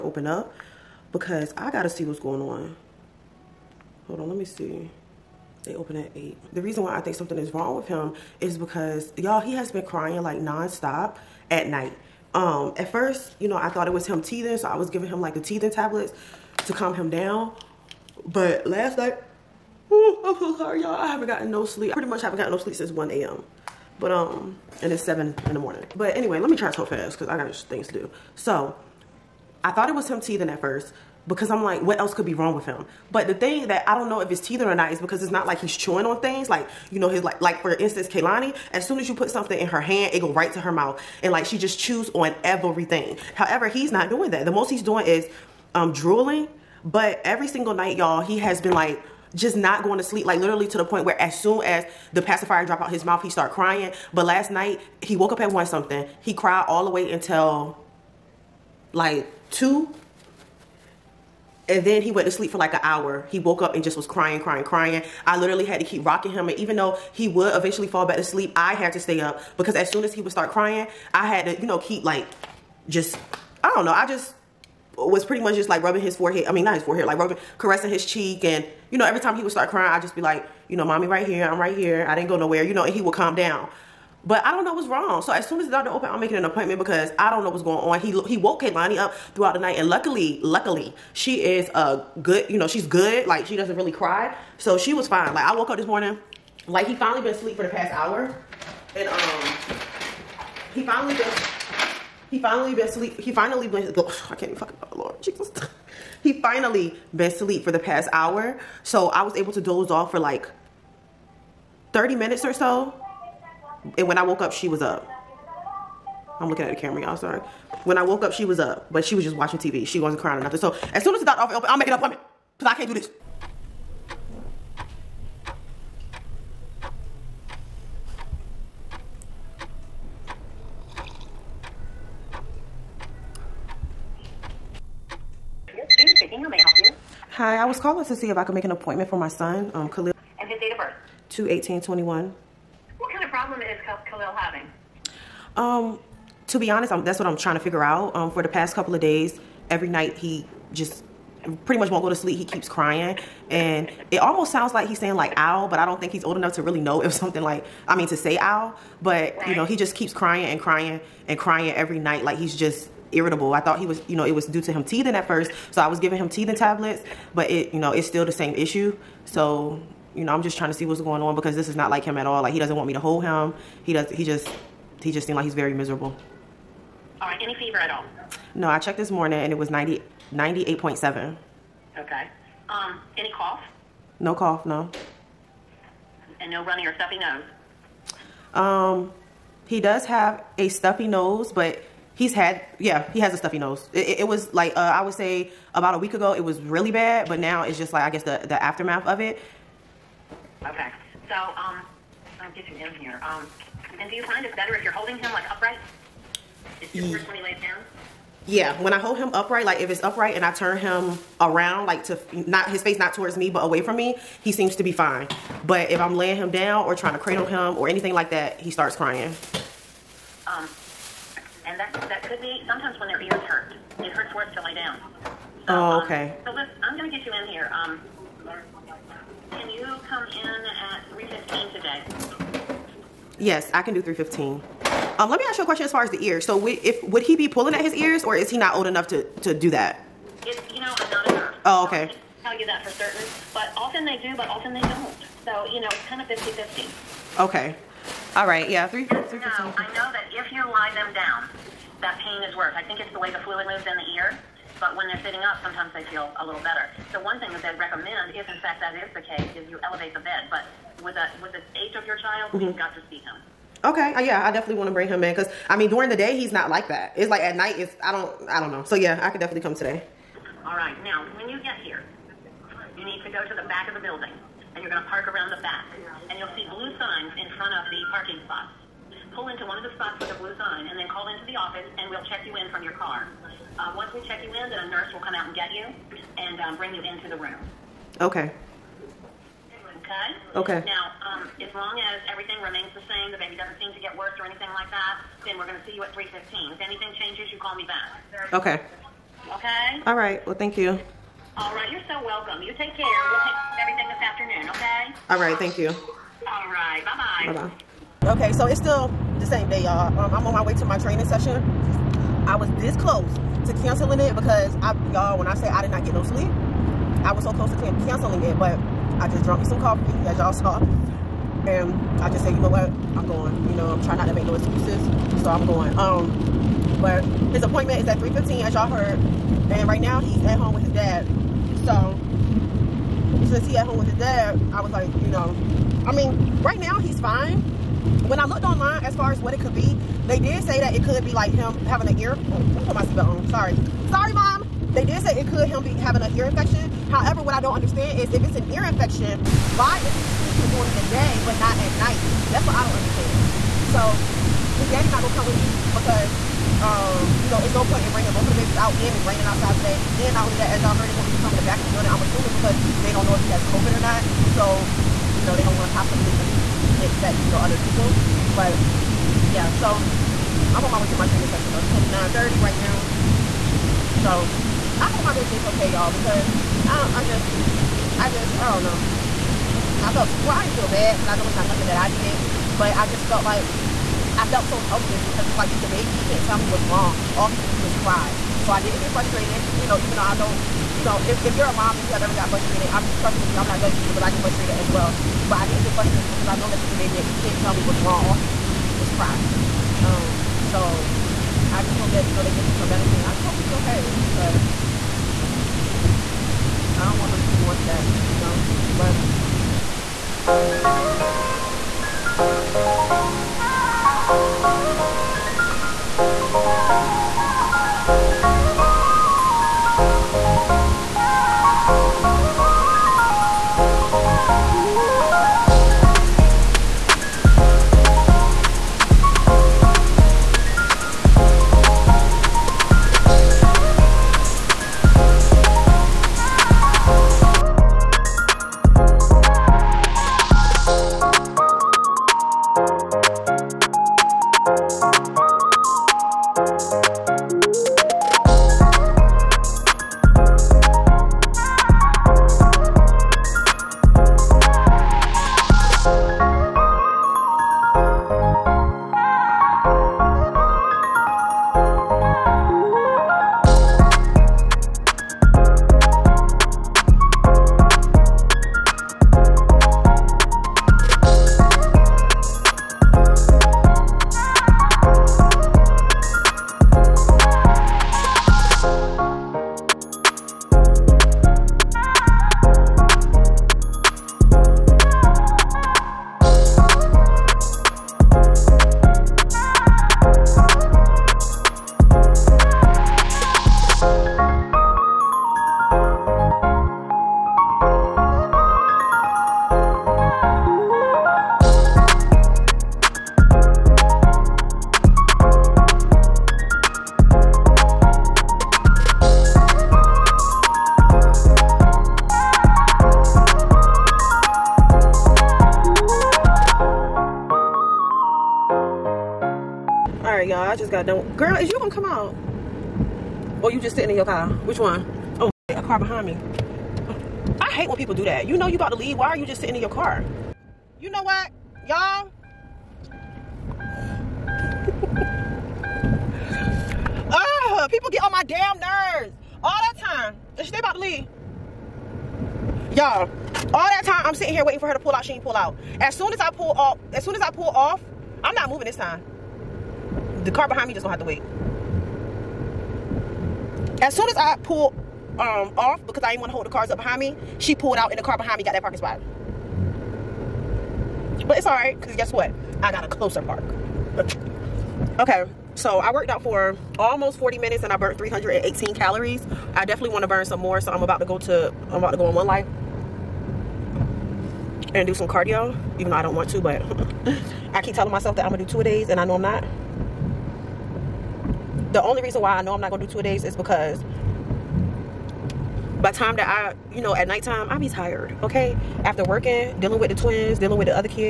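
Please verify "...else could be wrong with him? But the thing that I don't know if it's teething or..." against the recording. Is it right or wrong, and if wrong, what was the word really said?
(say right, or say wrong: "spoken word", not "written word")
right.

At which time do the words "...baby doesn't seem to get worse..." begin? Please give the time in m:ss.
4:53.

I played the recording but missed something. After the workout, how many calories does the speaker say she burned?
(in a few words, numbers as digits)
318.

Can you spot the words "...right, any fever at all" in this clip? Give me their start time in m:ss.
2:57.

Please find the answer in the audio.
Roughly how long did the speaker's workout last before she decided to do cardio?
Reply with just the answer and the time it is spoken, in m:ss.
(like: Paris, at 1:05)
40 minutes, at 9:26.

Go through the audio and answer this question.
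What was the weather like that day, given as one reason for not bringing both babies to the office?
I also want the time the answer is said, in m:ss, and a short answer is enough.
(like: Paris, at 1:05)
raining, at 5:59.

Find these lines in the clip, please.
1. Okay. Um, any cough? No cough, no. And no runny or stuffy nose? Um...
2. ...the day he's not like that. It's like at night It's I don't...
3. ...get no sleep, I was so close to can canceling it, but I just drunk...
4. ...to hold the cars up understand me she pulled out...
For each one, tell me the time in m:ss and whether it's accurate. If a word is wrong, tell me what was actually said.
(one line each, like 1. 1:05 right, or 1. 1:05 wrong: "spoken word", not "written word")
1. 3:01 right
2. 4:26 right
3. 5:16 right
4. 9:16 wrong: "behind", not "understand".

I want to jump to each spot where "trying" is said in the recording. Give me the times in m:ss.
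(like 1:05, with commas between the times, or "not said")
2:27, 2:50, 3:36, 5:24.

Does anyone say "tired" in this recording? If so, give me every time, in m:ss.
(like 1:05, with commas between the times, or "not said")
9:47.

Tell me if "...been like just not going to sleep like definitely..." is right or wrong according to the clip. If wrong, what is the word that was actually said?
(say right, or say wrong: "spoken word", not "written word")
wrong: "literally", not "definitely".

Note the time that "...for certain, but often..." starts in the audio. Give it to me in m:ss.
4:02.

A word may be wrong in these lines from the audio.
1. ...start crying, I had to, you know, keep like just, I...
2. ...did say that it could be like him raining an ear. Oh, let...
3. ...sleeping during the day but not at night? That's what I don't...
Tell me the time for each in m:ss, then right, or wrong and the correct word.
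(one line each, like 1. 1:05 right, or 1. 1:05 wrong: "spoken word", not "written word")
1. 1:10 right
2. 5:40 wrong: "having", not "raining"
3. 5:50 right.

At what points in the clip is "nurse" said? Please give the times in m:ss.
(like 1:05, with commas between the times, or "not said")
4:01, 4:44.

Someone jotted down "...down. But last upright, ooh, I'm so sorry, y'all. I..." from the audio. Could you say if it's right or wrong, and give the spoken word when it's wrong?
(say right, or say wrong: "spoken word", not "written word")
wrong: "night", not "upright".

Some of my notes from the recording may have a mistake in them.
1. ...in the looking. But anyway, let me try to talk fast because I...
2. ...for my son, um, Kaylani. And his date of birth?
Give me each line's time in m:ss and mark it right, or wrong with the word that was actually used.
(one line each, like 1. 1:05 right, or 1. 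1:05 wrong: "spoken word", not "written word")
1. 0:25 wrong: "morning", not "looking"
2. 2:19 wrong: "Khalil", not "Kaylani".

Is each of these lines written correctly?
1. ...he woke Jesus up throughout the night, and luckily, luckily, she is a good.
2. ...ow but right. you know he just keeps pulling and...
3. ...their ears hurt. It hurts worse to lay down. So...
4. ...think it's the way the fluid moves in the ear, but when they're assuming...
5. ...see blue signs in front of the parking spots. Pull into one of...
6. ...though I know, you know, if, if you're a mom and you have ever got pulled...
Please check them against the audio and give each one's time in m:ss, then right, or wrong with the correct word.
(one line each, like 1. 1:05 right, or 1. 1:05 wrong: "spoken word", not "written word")
1. 1:28 wrong: "Kaylani", not "Jesus"
2. 2:38 wrong: "crying", not "pulling"
3. 3:43 right
4. 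4:12 wrong: "sitting", not "assuming"
5. 4:36 right
6. 6:30 wrong: "frustrated", not "pulled".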